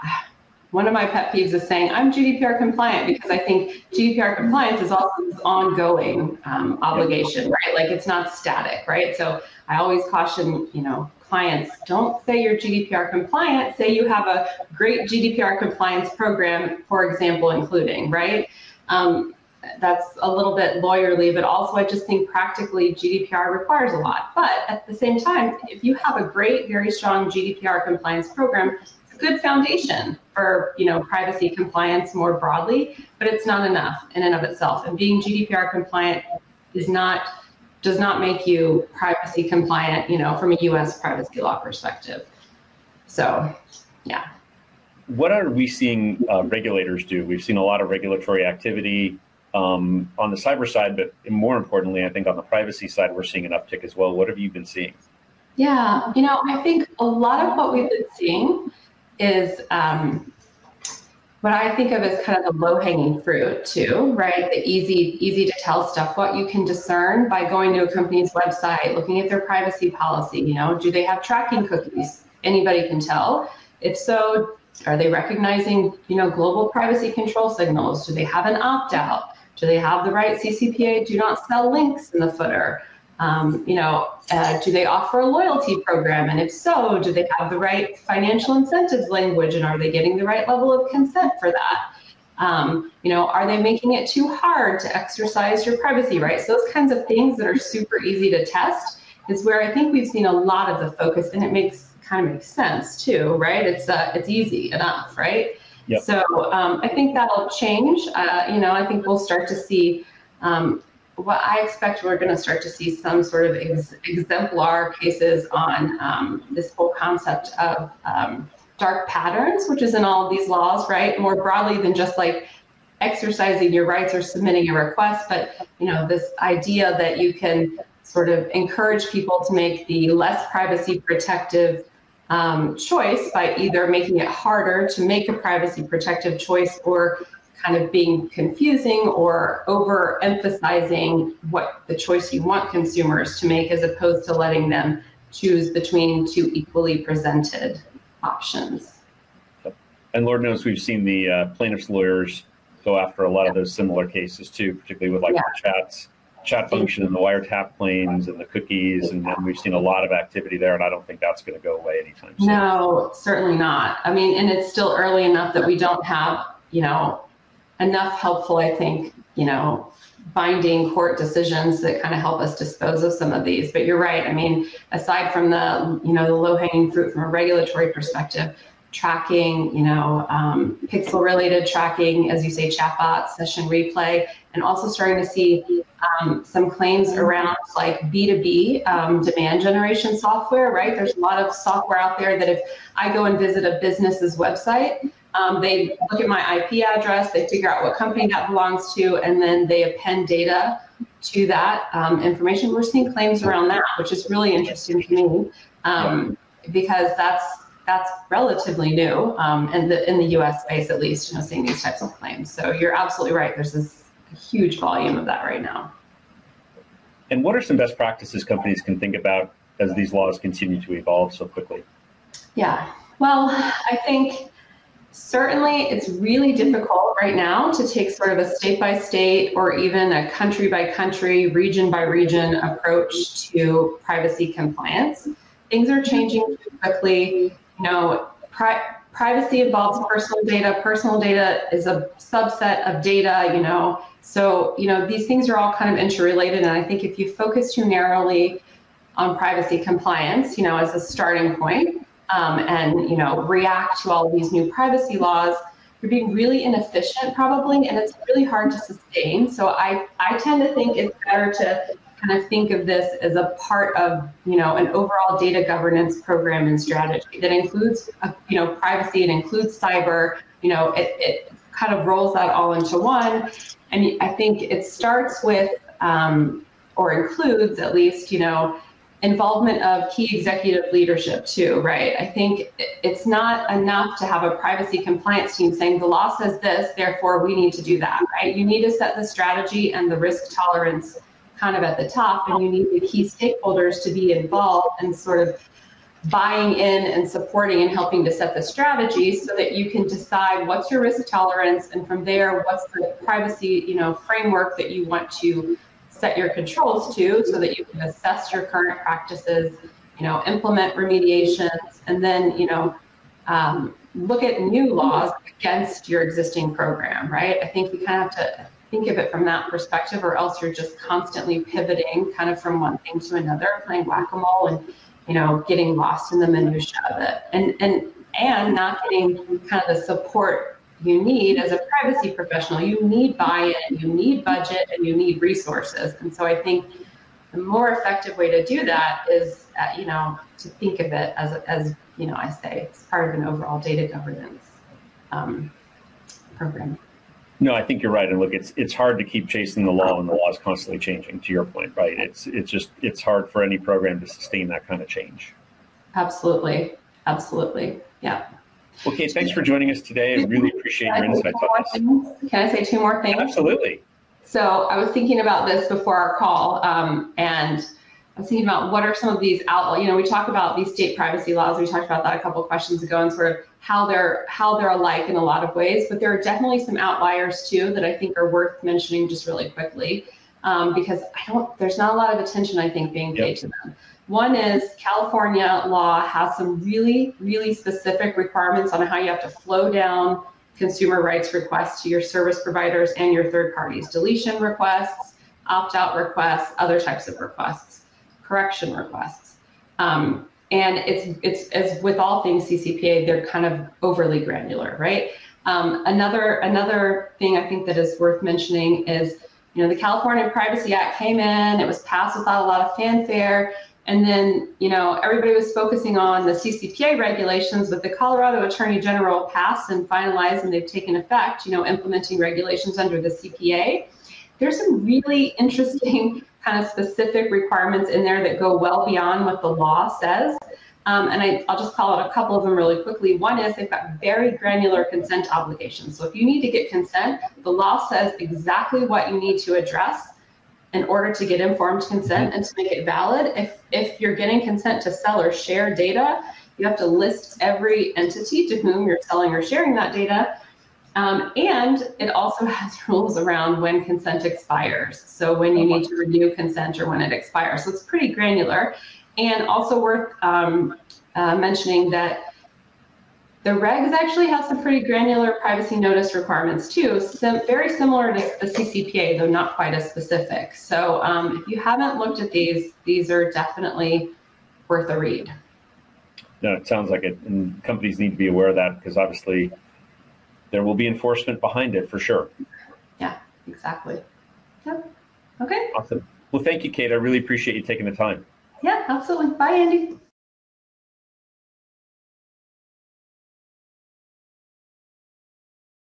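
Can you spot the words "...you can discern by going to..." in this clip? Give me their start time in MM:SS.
01:06.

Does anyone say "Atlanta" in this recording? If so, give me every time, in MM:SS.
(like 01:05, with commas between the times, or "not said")
not said.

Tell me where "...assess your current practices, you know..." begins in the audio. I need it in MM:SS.
05:08.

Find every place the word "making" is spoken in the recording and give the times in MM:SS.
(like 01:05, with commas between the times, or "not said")
01:33, 02:13.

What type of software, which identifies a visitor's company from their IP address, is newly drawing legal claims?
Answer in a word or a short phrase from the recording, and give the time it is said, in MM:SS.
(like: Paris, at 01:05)
B2B demand generation software, at 03:08.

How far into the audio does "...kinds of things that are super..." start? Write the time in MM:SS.
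01:36.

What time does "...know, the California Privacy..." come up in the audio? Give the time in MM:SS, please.
06:49.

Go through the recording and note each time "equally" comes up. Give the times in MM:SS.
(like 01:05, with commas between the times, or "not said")
02:26.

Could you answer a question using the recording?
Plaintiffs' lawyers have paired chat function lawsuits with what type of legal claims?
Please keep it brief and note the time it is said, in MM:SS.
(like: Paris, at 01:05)
wiretap claims, at 02:37.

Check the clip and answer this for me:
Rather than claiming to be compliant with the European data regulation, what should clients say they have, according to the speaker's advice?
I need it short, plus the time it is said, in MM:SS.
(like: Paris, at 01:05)
a great GDPR compliance program, at 00:14.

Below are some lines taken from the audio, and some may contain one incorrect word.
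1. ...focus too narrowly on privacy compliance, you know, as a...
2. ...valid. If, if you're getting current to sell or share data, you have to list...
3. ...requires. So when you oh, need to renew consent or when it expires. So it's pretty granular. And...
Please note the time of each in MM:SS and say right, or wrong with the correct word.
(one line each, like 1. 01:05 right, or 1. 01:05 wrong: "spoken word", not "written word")
1. 04:07 right
2. 07:23 wrong: "consent", not "current"
3. 07:34 wrong: "expires", not "requires".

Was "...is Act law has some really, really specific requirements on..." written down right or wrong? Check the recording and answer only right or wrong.
wrong.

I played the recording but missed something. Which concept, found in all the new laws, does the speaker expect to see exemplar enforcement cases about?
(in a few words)
dark patterns.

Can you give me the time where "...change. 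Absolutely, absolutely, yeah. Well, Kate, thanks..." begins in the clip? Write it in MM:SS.
05:55.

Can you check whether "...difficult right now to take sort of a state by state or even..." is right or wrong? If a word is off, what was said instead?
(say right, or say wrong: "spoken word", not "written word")
right.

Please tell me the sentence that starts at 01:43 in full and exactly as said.
It's uh, it's easy enough, right?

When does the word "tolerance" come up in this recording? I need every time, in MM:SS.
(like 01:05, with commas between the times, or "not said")
04:50, 05:01.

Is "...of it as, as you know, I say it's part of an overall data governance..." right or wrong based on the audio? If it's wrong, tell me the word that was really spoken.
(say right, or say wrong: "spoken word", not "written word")
right.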